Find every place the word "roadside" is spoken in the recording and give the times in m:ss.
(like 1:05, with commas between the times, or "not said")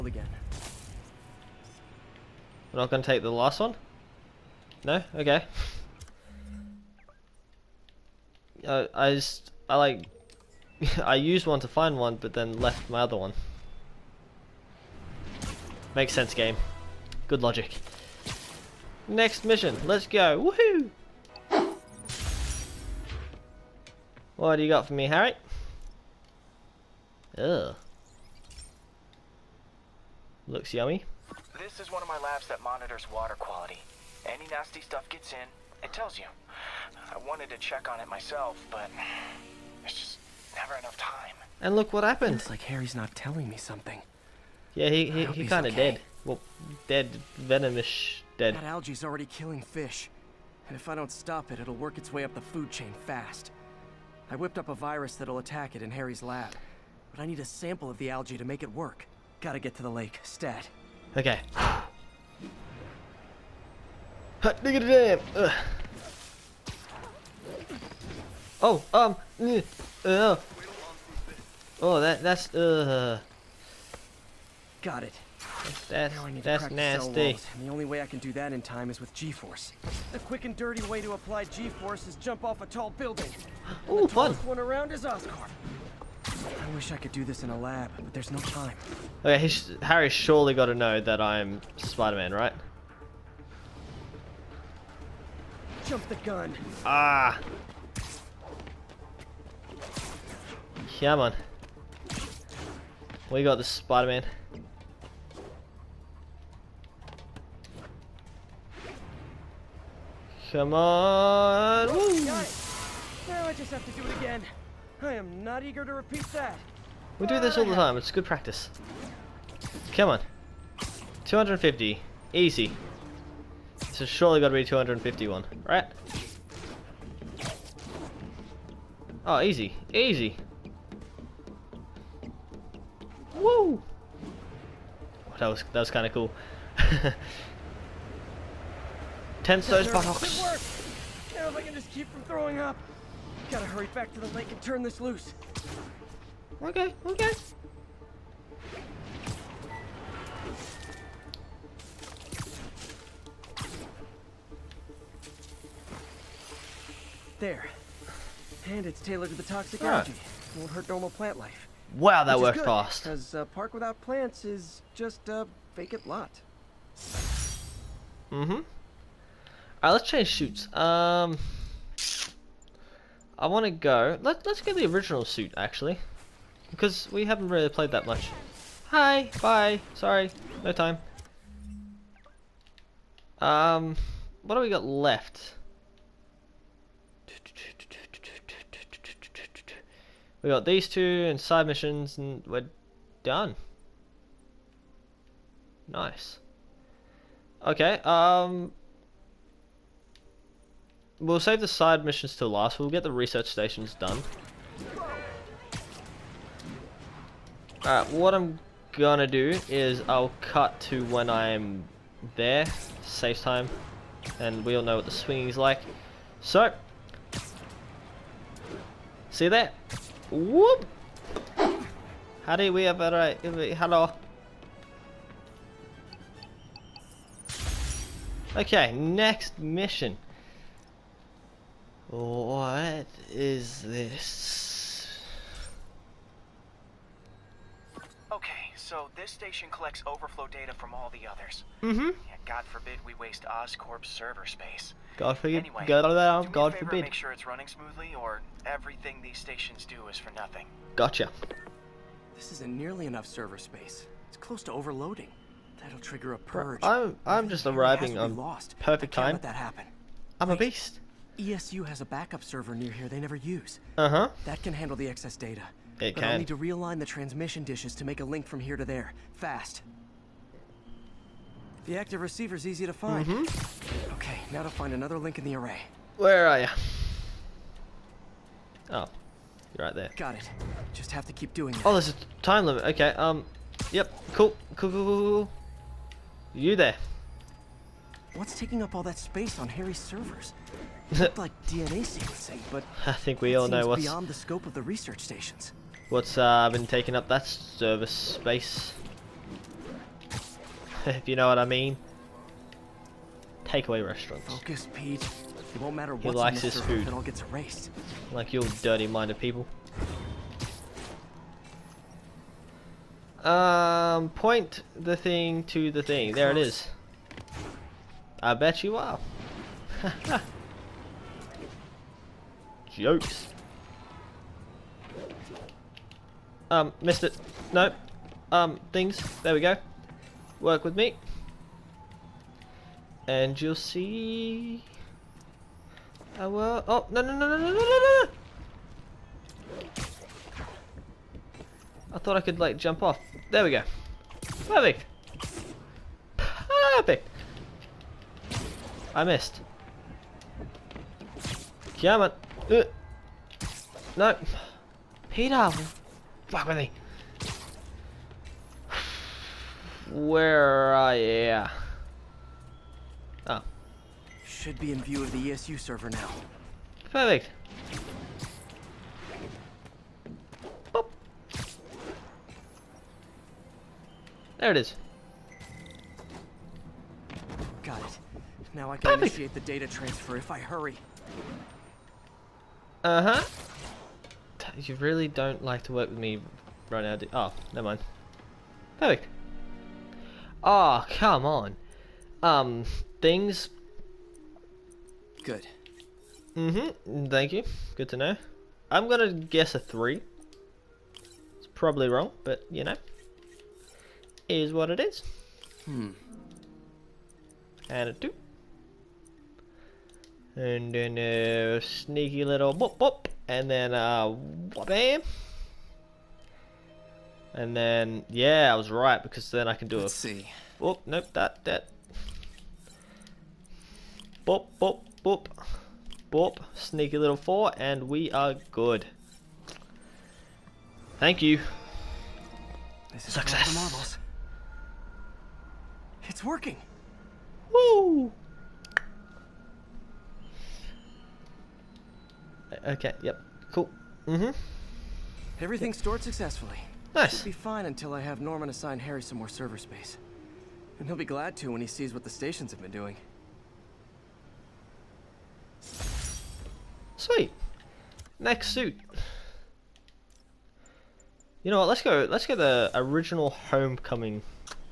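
not said.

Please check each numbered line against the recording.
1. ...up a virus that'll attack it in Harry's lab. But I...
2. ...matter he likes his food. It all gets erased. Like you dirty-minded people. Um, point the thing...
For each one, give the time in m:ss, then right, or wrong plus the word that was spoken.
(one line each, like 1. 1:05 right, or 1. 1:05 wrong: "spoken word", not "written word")
1. 0:54 right
2. 5:05 right.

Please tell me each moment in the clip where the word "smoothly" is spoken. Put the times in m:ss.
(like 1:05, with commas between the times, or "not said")
4:07.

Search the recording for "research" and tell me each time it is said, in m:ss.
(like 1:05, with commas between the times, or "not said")
3:23, 4:54.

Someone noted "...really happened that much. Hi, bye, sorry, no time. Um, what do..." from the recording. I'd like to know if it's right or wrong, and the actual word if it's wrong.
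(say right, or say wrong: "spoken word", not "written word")
wrong: "played", not "happened".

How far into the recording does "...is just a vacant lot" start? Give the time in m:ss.
2:44.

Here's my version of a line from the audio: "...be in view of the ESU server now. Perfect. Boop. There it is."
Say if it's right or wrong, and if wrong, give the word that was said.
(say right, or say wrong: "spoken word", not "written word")
right.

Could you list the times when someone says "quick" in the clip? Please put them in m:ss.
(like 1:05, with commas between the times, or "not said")
1:20.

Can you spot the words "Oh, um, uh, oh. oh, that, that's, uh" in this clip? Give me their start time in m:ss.
1:08.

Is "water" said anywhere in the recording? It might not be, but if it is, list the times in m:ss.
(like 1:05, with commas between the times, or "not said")
0:33.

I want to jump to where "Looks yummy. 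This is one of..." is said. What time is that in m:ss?
0:30.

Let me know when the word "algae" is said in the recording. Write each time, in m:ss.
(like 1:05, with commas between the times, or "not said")
0:48, 0:58, 2:39.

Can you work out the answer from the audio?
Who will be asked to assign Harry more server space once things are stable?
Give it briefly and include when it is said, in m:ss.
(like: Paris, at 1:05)
Norman, at 7:28.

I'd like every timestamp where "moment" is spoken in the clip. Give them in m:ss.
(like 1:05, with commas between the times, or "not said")
not said.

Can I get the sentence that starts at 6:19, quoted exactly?
initiate the data transfer if I hurry.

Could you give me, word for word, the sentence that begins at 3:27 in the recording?
Alright, what I'm gonna do is I'll cut to when I'm there.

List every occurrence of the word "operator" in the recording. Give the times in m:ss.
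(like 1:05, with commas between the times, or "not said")
not said.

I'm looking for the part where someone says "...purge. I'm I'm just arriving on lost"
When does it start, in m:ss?
4:16.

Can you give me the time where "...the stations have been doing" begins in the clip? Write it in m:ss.
7:32.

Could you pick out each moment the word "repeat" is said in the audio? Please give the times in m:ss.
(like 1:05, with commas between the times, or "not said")
1:55.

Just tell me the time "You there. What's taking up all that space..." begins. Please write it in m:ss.
4:46.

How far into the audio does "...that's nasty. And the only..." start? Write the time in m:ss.
1:16.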